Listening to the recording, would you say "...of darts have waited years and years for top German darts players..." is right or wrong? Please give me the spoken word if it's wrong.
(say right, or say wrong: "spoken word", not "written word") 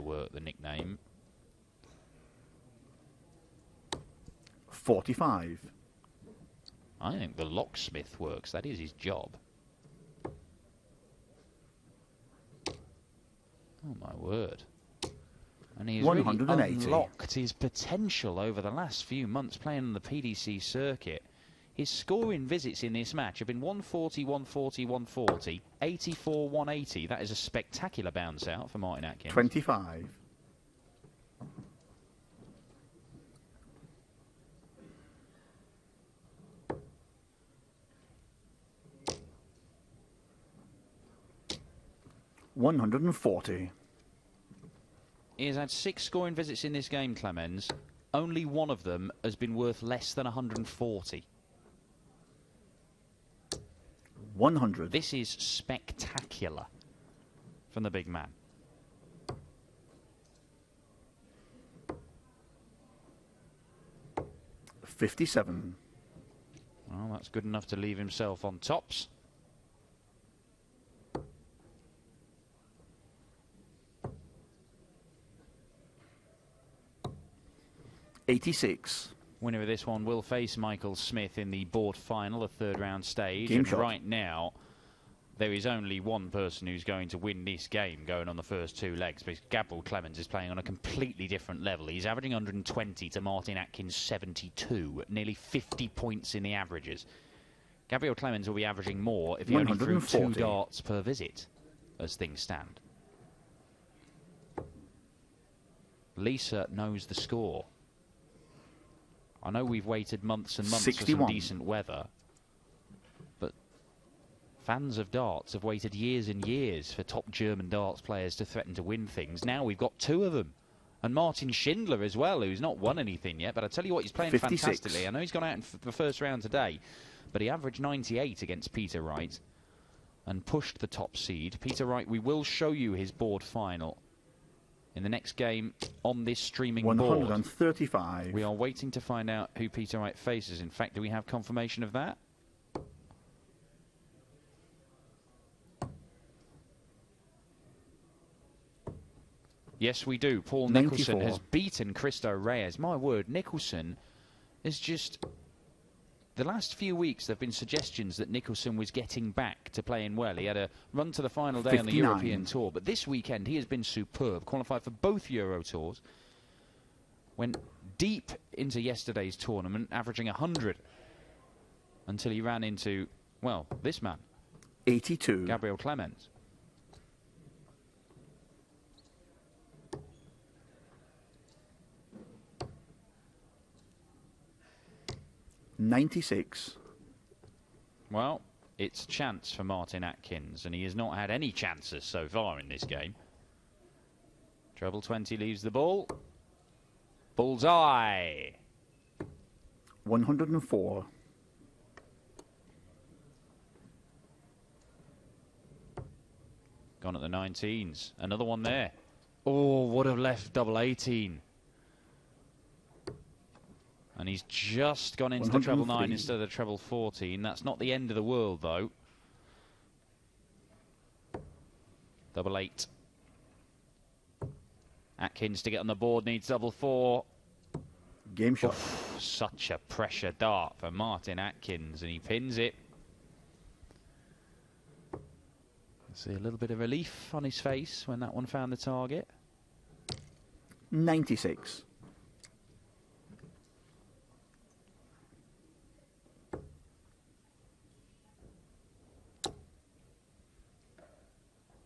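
right.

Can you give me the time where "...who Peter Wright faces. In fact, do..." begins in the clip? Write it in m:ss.
2:19.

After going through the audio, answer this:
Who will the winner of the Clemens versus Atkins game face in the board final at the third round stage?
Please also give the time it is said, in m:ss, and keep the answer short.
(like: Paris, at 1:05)
Michael Smith, at 1:20.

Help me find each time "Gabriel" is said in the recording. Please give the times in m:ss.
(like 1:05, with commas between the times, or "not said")
1:29, 1:37, 2:55.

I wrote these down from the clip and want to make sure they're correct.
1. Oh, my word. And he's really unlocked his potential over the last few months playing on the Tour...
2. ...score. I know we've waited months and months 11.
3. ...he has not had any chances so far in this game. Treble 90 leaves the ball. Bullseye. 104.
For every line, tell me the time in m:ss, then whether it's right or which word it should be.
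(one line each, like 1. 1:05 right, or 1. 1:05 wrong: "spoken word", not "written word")
1. 0:13 wrong: "PDC", not "Tour"
2. 1:47 wrong: "61", not "11"
3. 3:10 wrong: "20", not "90".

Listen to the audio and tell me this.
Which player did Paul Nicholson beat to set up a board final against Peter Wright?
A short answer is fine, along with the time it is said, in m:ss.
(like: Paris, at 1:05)
Cristo Reyes, at 2:31.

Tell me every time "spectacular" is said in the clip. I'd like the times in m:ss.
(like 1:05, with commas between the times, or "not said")
0:27, 0:55.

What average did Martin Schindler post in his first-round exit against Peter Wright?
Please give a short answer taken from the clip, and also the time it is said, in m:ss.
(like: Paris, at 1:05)
98, at 2:07.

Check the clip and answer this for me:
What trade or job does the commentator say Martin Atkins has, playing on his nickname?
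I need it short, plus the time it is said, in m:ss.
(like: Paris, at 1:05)
Locksmith, at 0:07.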